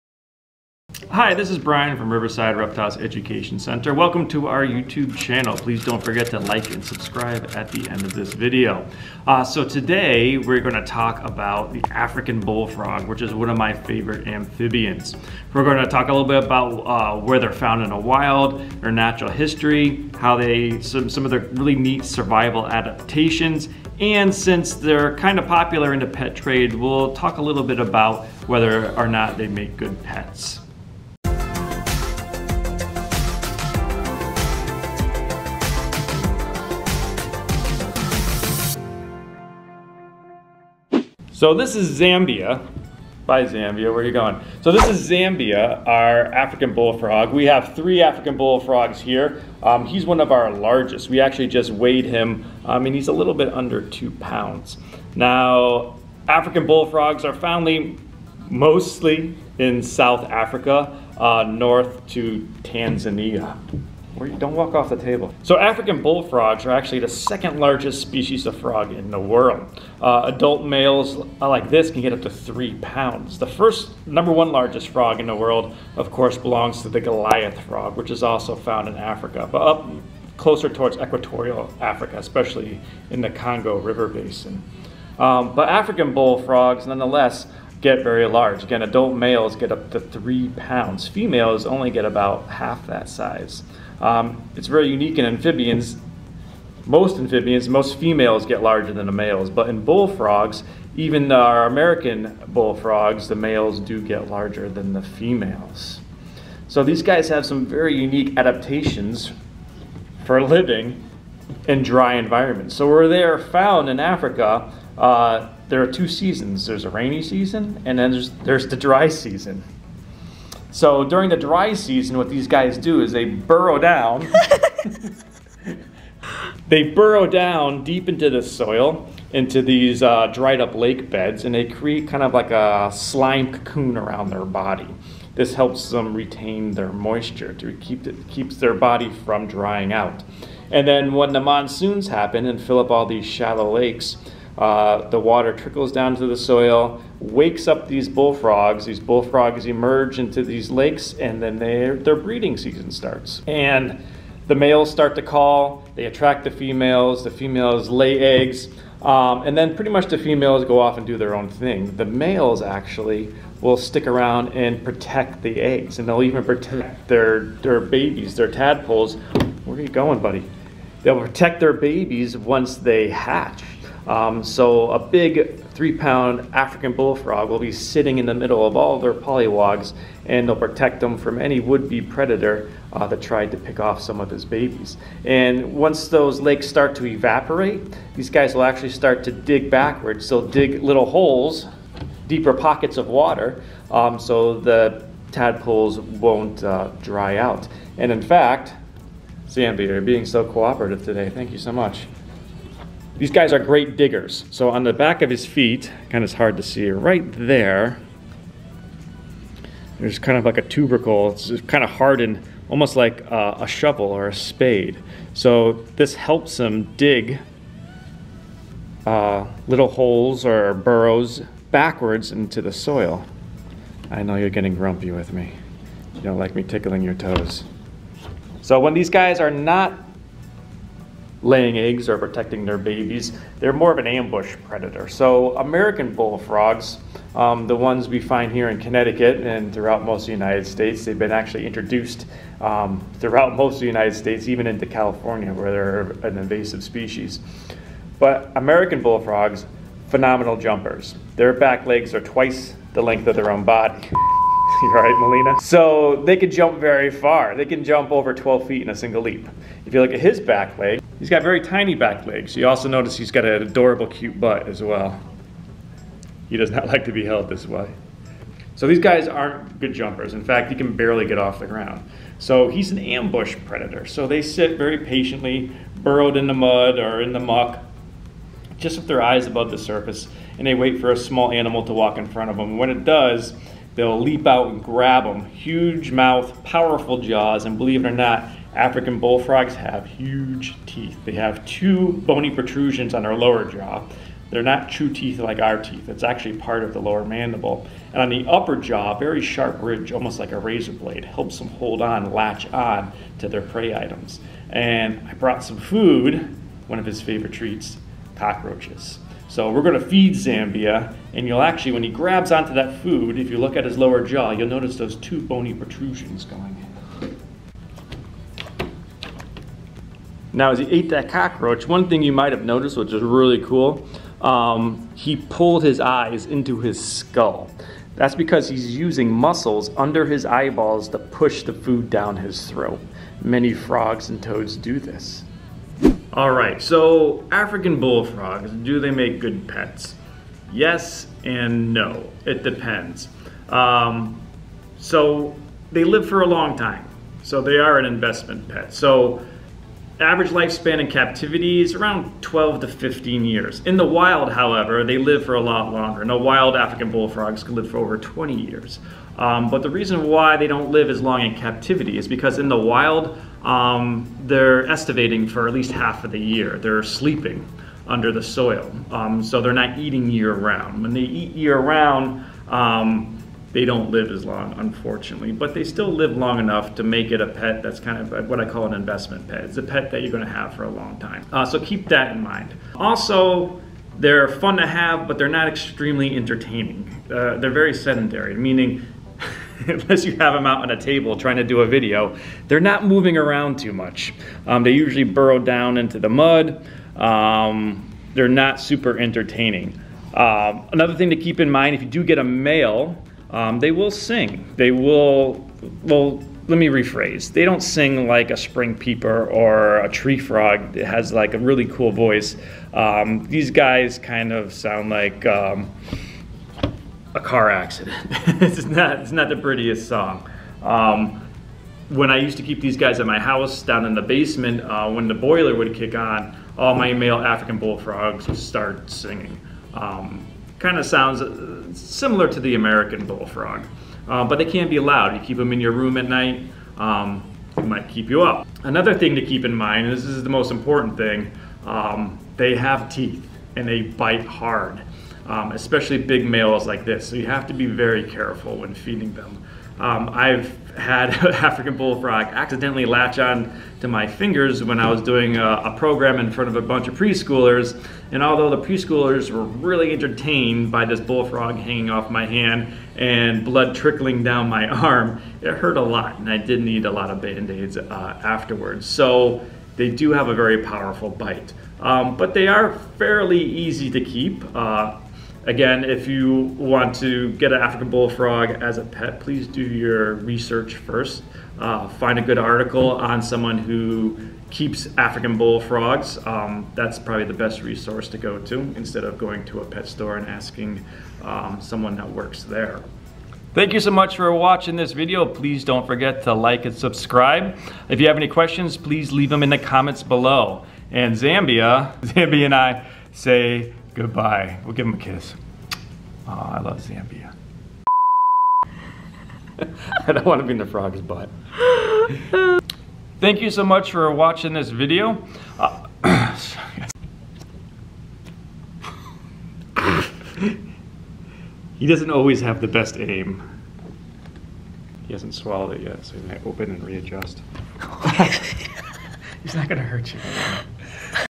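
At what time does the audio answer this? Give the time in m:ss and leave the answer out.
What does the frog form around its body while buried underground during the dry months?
2:12.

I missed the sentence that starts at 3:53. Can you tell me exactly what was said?
They're more of an ambush predator.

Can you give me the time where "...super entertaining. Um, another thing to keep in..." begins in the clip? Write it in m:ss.
6:38.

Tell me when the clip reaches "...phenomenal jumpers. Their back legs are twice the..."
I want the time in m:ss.
4:10.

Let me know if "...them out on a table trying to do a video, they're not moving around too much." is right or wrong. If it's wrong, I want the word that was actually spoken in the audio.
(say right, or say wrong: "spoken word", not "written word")
right.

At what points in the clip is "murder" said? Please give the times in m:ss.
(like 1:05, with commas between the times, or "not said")
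not said.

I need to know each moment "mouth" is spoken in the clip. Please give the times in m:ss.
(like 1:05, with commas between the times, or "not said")
4:46.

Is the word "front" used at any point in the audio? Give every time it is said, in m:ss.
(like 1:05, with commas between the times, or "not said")
4:42, 7:36.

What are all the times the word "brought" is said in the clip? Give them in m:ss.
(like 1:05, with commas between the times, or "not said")
5:05.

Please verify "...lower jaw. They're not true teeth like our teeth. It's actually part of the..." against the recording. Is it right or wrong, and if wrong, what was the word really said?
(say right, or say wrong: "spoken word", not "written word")
right.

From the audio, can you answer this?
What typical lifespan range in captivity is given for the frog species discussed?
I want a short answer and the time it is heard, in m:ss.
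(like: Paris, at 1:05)
12 to 15 years, at 5:52.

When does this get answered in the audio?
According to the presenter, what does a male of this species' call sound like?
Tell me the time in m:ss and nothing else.
6:57.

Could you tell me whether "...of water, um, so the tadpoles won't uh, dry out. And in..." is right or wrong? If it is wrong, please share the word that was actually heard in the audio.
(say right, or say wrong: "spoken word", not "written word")
right.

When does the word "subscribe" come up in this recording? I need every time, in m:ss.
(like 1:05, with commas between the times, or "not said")
0:06, 8:16.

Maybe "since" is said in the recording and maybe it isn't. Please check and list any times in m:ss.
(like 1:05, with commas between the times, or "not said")
0:24.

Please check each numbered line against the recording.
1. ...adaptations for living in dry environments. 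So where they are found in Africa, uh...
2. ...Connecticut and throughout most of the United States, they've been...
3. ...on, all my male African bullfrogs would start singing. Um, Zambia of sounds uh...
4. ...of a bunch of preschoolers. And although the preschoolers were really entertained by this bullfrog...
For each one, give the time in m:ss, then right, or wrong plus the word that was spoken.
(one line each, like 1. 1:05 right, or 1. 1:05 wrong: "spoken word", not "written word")
1. 1:48 right
2. 3:58 right
3. 7:06 wrong: "Kind", not "Zambia"
4. 7:36 right.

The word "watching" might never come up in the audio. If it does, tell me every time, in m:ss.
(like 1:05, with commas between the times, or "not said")
8:14, 8:34.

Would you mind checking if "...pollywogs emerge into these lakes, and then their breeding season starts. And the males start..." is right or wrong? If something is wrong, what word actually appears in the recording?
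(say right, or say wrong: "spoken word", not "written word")
wrong: "bullfrogs", not "pollywogs".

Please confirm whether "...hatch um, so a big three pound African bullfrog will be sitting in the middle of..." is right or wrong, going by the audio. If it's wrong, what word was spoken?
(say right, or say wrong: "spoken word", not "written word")
right.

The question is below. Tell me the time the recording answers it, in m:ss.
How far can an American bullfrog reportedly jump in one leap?
4:18.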